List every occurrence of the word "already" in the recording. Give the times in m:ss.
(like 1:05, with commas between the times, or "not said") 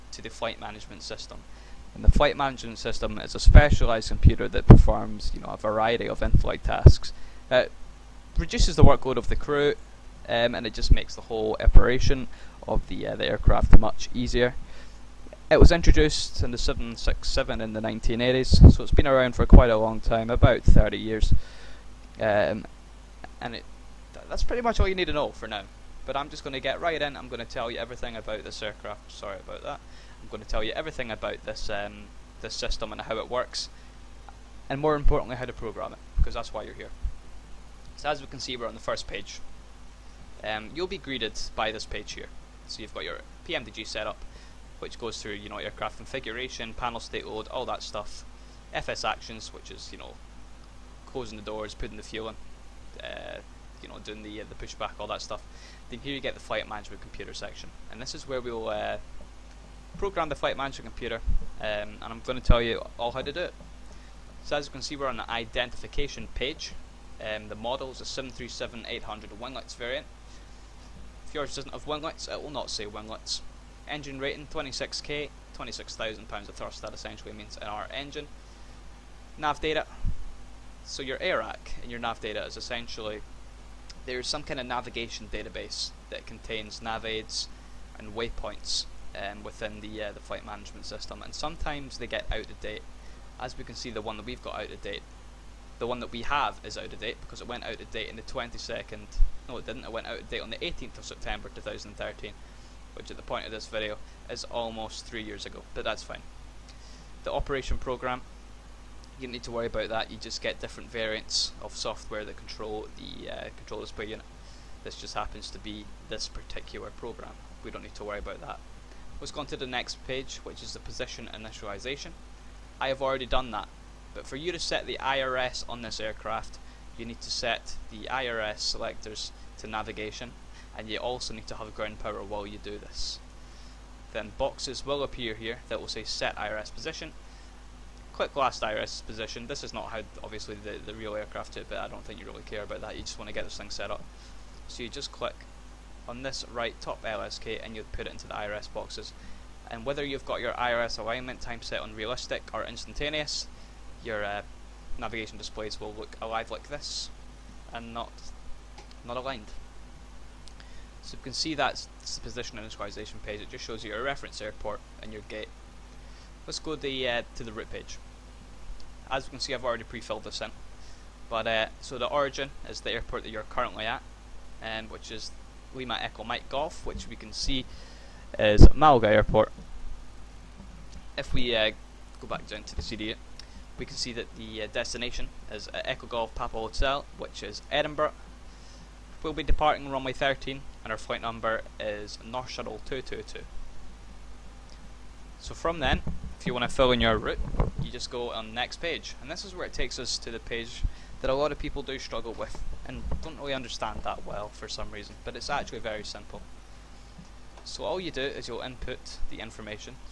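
2:03, 2:49.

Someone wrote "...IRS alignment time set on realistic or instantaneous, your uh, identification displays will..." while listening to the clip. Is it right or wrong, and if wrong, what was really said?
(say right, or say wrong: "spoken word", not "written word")
wrong: "navigation", not "identification".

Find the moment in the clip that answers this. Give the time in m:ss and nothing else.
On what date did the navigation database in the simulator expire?
1:40.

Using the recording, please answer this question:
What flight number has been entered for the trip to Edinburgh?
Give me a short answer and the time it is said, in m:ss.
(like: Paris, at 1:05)
North Shuttle 222, at 3:12.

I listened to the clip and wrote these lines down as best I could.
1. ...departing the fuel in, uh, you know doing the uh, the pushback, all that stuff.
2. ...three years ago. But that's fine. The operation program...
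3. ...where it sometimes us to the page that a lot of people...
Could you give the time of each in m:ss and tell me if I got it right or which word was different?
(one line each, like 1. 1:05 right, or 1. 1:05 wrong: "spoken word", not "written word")
1. 0:51 wrong: "putting", not "departing"
2. 1:45 right
3. 3:19 wrong: "takes", not "sometimes".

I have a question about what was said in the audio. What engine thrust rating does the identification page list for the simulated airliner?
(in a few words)
26,000 pounds.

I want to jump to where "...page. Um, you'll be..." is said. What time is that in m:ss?
0:39.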